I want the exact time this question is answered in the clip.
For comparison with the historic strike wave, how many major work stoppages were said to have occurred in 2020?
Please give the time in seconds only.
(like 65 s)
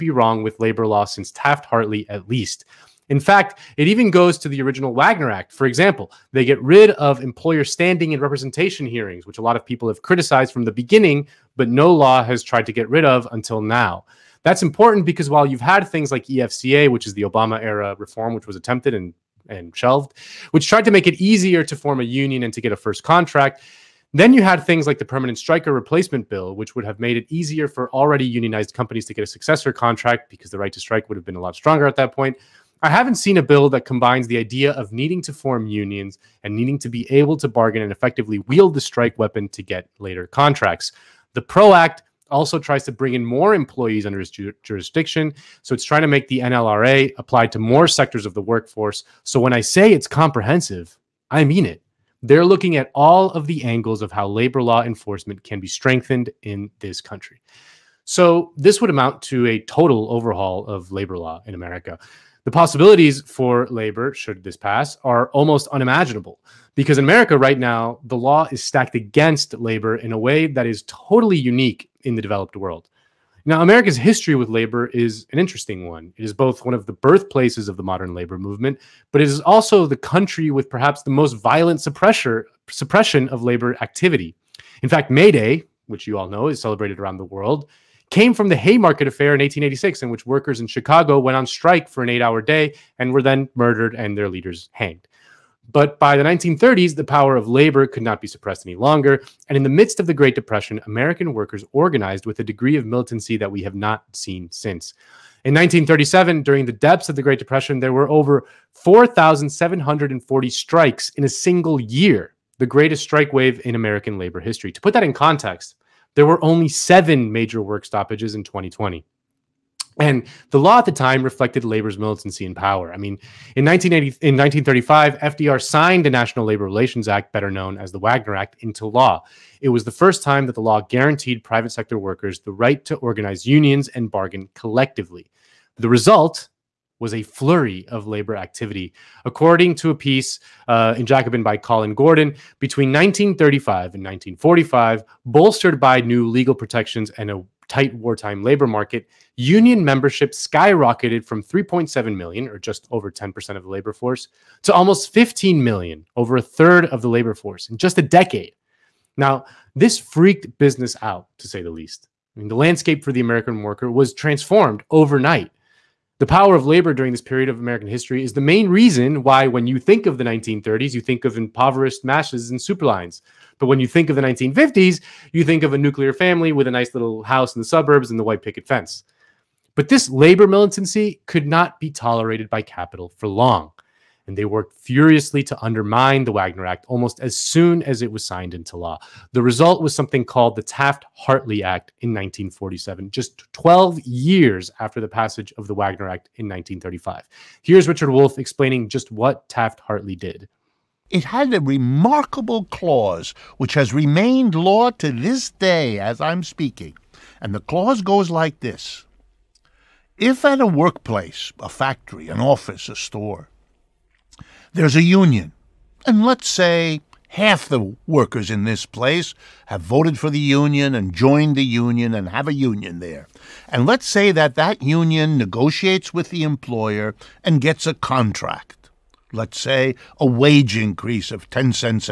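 116 s.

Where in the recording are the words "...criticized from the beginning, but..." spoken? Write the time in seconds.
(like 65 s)
10 s.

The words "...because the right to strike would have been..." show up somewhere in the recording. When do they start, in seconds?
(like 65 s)
30 s.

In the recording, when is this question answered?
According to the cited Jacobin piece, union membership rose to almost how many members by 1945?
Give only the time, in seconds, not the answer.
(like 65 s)
155 s.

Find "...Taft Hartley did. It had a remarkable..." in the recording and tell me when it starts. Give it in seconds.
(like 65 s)
199 s.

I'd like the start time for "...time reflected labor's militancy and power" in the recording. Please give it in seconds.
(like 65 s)
120 s.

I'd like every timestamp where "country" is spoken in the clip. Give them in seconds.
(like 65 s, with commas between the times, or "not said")
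57 s, 79 s.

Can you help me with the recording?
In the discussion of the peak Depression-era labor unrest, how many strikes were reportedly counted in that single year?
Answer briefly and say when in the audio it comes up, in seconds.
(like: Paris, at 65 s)
4,740, at 108 s.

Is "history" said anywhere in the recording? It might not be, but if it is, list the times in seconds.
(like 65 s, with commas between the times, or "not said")
73 s, 114 s, 167 s.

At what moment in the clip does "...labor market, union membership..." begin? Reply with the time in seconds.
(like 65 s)
148 s.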